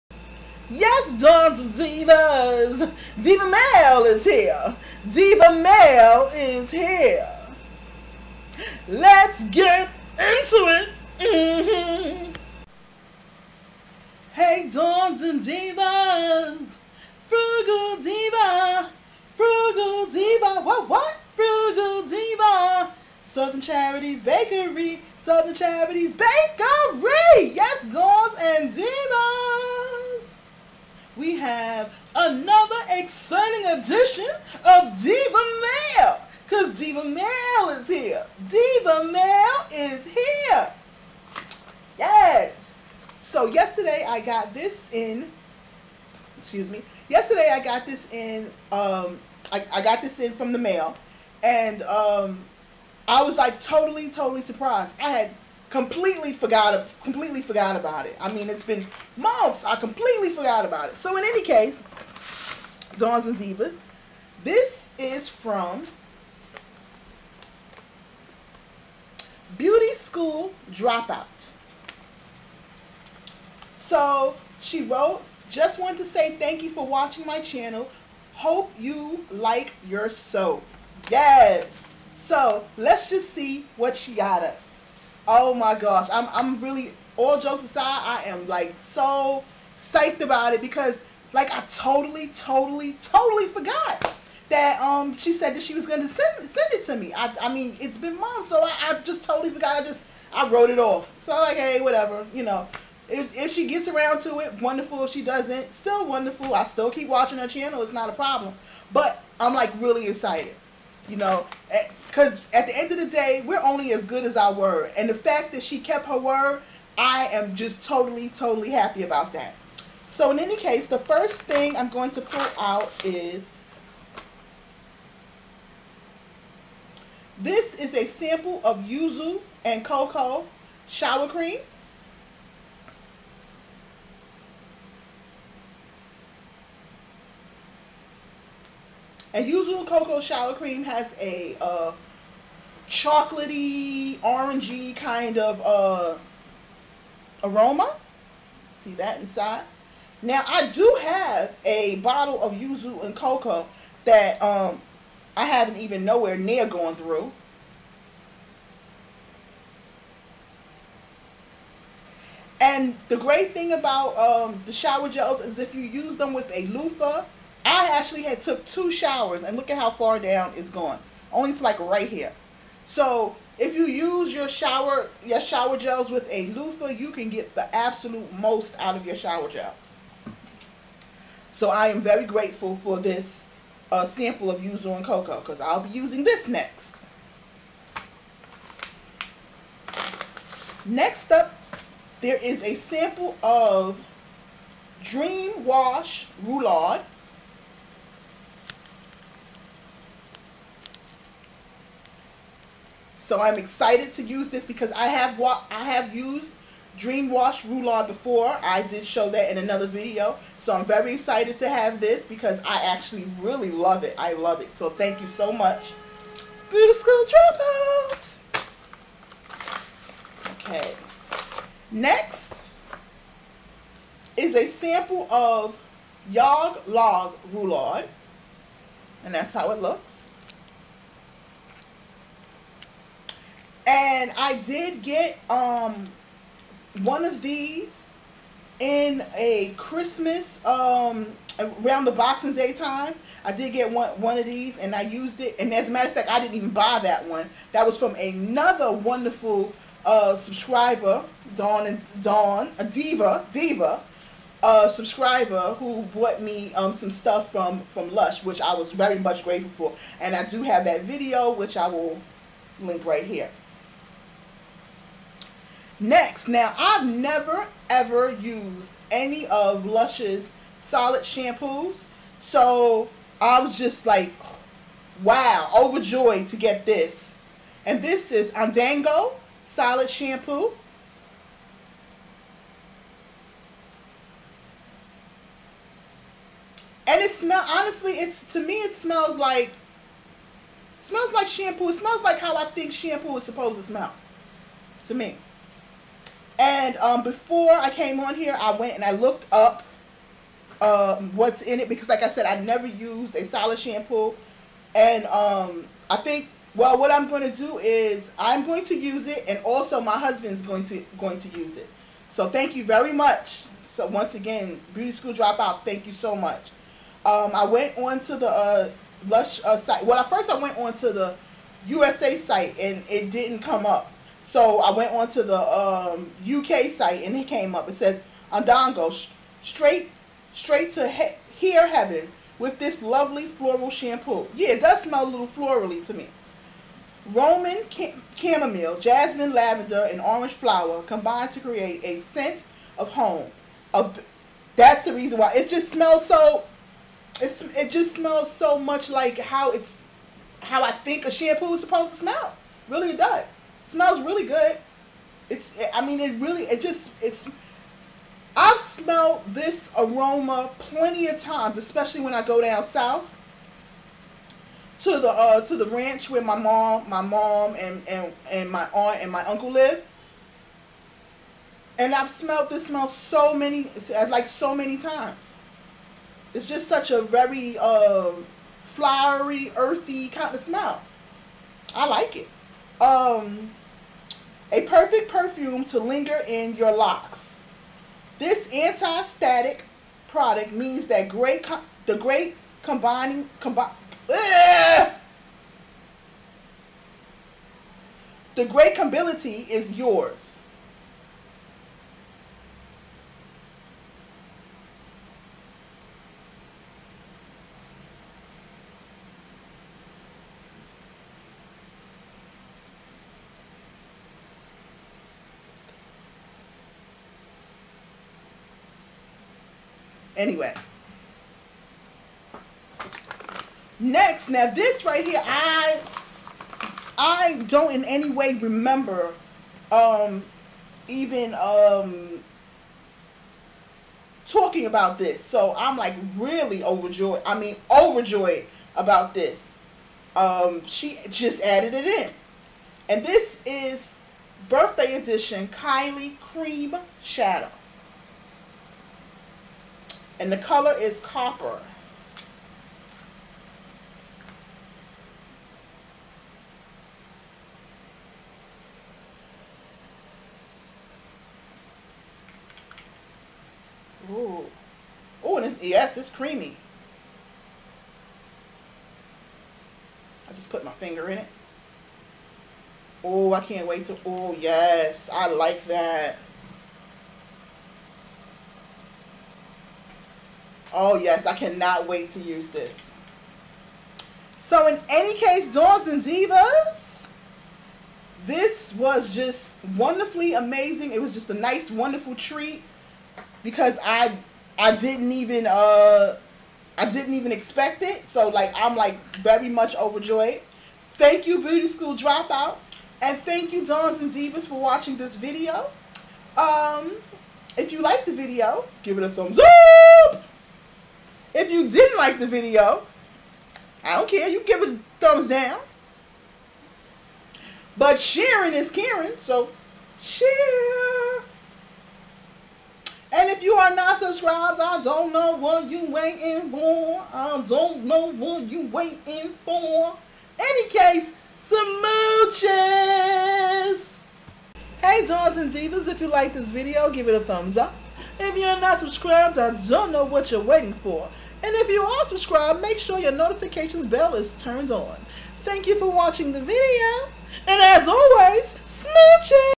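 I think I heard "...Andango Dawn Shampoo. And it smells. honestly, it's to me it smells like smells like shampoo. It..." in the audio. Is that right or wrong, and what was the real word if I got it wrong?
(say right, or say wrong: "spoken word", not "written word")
wrong: "Solid", not "Dawn".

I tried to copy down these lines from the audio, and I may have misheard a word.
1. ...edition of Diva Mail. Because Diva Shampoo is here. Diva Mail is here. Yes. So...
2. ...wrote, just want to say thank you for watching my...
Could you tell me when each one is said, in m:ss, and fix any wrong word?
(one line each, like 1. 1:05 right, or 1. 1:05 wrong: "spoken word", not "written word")
1. 0:33 wrong: "Mail", not "Shampoo"
2. 1:14 right.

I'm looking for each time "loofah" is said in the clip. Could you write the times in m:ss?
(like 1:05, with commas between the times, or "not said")
2:46, 2:56.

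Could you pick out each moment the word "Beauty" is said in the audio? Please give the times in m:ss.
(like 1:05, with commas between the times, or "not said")
1:09, 3:36, 5:14, 8:21.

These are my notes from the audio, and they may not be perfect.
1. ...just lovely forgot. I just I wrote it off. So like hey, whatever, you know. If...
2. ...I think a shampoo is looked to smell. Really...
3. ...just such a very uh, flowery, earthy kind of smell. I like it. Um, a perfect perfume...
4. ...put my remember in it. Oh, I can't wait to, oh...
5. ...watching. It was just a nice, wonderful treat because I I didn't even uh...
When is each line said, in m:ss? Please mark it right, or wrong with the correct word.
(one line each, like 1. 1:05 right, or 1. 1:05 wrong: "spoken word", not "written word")
1. 1:39 wrong: "totally", not "lovely"
2. 5:50 wrong: "supposed", not "looked"
3. 6:16 right
4. 7:50 wrong: "finger", not "remember"
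5. 8:10 wrong: "amazing", not "watching".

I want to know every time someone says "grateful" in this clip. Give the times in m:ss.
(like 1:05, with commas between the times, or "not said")
3:02, 4:19.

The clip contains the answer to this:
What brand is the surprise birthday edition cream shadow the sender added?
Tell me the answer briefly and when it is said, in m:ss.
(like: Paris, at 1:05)
Kylie, at 7:25.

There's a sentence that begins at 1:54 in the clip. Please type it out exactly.
And the fact that she kept her word, I am just totally, totally happy about that.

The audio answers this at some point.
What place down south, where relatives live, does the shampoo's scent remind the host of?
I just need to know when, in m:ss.
6:05.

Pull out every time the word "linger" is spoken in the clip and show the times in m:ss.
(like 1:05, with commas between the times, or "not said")
6:25.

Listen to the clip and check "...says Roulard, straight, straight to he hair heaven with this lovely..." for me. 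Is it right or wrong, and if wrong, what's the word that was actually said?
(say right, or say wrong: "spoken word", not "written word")
wrong: "Andango", not "Roulard".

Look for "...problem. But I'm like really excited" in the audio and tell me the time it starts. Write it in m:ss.
1:48.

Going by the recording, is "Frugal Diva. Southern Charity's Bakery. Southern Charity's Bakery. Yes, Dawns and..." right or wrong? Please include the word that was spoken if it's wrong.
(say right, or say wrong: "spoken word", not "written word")
right.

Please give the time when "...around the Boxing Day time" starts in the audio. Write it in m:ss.
4:01.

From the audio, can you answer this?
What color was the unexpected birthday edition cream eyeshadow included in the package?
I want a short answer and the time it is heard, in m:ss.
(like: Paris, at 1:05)
Copper, at 7:31.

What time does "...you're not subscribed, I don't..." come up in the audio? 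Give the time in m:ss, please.
8:58.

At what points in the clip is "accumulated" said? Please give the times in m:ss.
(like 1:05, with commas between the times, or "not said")
not said.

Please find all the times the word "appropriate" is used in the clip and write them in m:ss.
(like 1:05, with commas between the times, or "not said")
not said.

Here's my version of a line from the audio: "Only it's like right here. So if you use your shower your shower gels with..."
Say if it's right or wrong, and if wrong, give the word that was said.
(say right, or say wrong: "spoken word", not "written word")
right.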